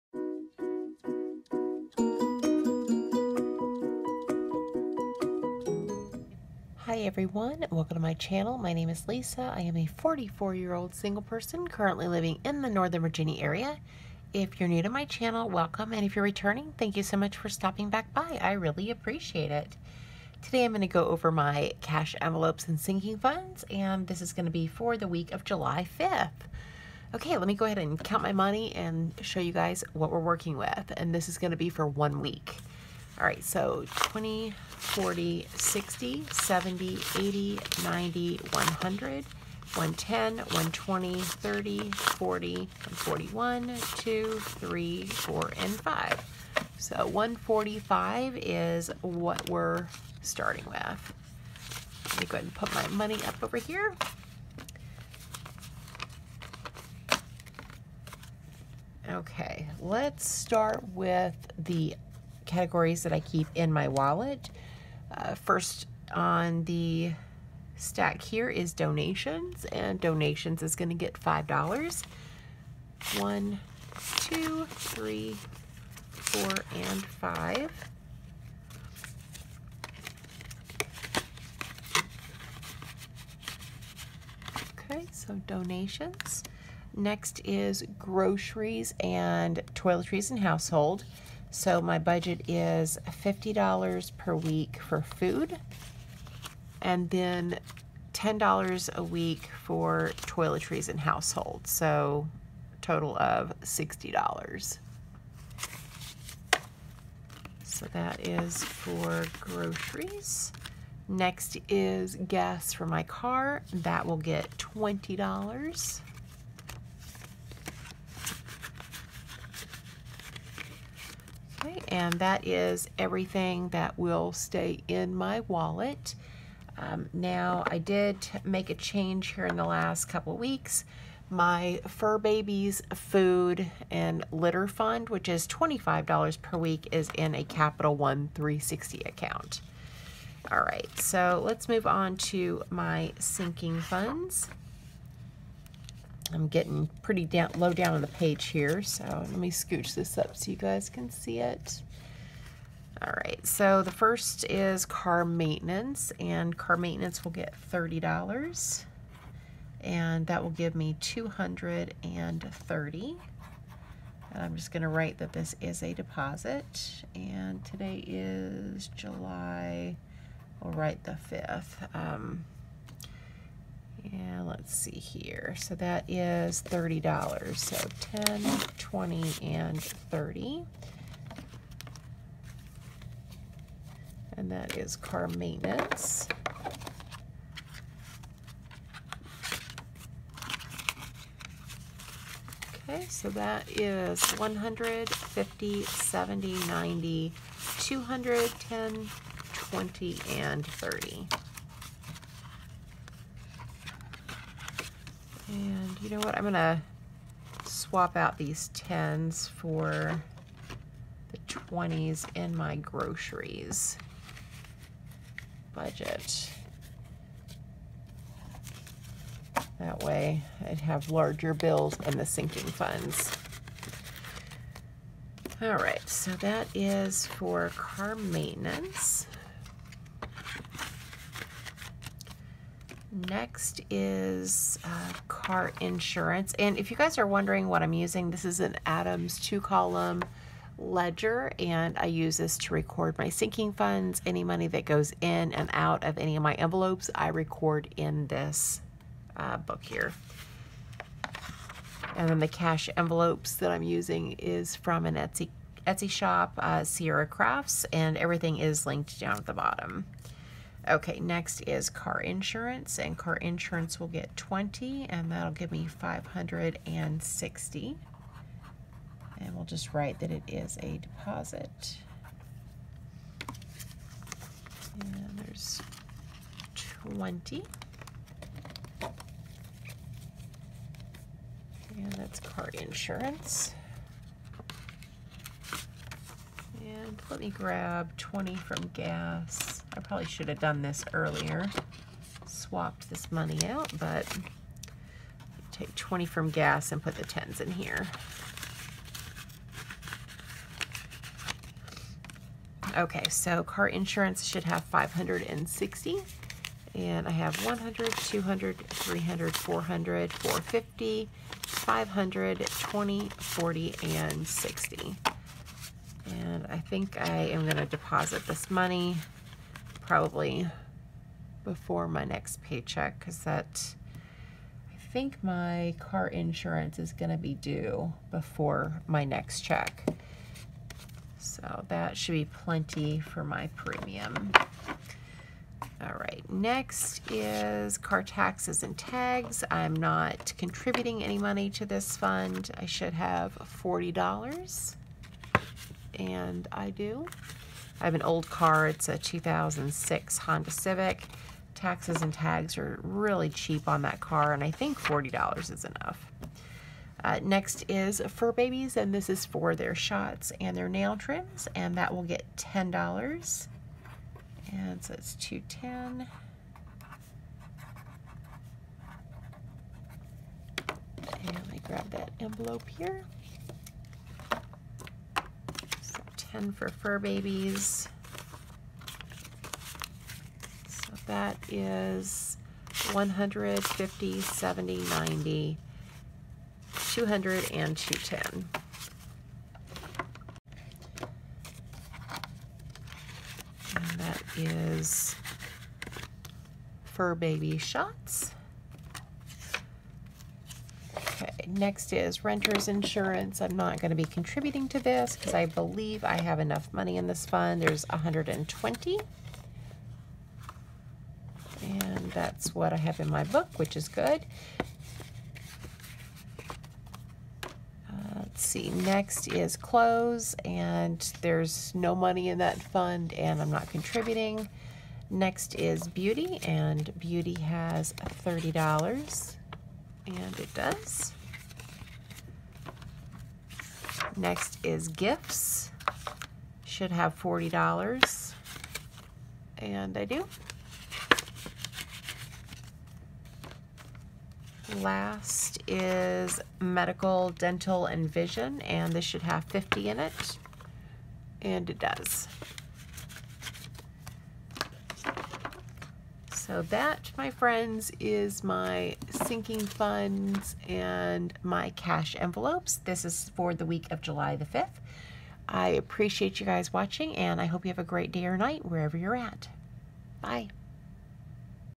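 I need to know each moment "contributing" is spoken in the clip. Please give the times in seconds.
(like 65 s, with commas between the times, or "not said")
340 s, 404 s, 423 s.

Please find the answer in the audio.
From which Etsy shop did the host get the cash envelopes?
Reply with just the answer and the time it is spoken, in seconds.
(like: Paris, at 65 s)
Sierra Crafts, at 256 s.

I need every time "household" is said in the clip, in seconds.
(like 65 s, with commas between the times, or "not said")
90 s, 100 s.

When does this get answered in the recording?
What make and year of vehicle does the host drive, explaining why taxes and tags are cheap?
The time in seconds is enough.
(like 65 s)
349 s.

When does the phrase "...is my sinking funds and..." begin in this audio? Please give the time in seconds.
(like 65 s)
458 s.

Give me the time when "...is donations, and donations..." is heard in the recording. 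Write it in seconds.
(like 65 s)
68 s.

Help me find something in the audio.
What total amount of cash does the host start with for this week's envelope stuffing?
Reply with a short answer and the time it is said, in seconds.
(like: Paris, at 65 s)
$145, at 47 s.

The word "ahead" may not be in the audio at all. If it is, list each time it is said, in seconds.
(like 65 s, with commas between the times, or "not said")
27 s, 52 s.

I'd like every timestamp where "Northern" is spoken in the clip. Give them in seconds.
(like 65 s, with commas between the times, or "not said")
12 s.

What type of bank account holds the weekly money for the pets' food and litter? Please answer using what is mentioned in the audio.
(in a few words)
Capital One 360.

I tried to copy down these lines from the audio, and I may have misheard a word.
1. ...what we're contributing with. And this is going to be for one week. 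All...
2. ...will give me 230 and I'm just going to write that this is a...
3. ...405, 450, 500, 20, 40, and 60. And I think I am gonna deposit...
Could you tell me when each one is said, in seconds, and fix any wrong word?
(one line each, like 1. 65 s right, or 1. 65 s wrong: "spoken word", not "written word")
1. 29 s wrong: "working", not "contributing"
2. 160 s right
3. 309 s wrong: "400", not "405".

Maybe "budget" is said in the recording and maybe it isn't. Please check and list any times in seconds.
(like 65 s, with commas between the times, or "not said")
91 s, 215 s.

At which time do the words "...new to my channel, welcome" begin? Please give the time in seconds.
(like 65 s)
14 s.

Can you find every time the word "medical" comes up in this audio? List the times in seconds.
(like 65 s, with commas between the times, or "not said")
446 s.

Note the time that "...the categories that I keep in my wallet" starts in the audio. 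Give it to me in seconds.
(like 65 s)
61 s.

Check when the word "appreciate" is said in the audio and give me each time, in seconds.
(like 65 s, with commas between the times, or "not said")
18 s, 465 s.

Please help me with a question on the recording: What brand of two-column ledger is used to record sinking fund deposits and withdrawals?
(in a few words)
Adams.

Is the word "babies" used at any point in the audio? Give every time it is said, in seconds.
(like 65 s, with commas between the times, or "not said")
132 s, 358 s, 377 s.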